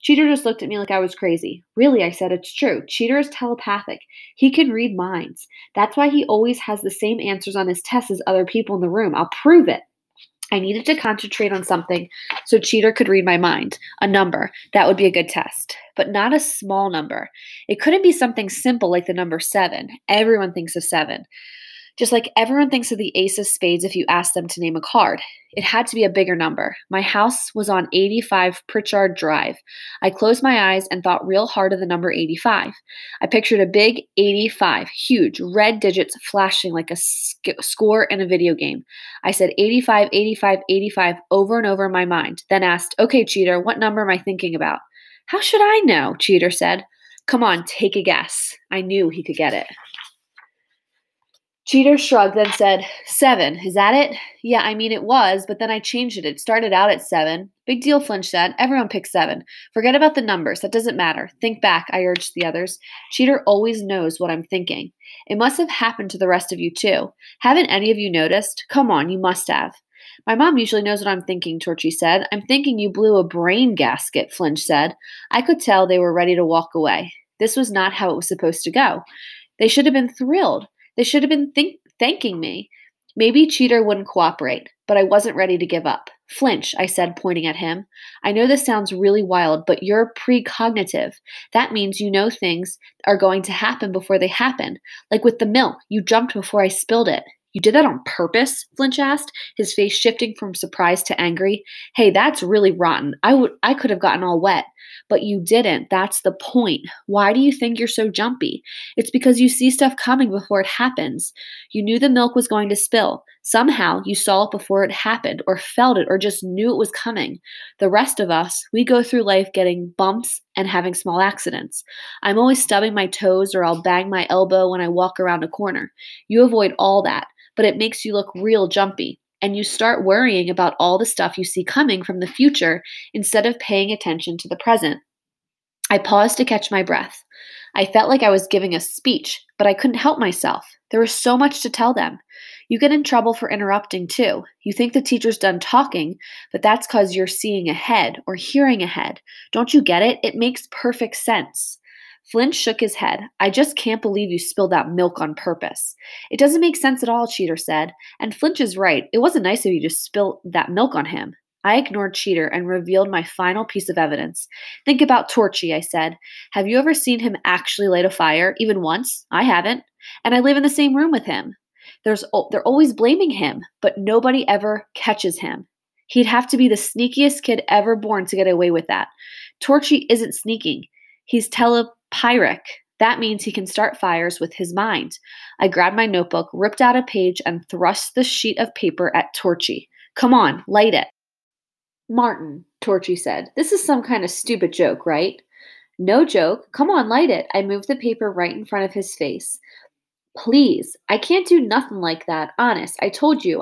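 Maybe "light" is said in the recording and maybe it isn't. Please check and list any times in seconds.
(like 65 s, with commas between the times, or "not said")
167 s, 190 s, 197 s.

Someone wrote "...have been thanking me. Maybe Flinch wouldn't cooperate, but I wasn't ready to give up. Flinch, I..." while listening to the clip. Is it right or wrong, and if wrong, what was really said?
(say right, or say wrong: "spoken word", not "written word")
wrong: "Cheater", not "Flinch".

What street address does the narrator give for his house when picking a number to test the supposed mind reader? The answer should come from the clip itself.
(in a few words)
85 Pritchard Drive.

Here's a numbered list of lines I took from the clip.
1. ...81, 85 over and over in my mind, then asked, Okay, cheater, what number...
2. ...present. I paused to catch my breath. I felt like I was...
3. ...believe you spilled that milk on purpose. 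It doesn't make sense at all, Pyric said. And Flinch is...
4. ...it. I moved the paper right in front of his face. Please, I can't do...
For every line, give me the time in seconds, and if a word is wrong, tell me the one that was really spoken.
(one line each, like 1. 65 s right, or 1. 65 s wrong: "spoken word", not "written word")
1. 40 s wrong: "85", not "81"
2. 134 s right
3. 154 s wrong: "Cheater", not "Pyric"
4. 197 s right.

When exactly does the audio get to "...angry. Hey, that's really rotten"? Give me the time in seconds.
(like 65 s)
101 s.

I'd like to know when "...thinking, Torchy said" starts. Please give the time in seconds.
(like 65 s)
71 s.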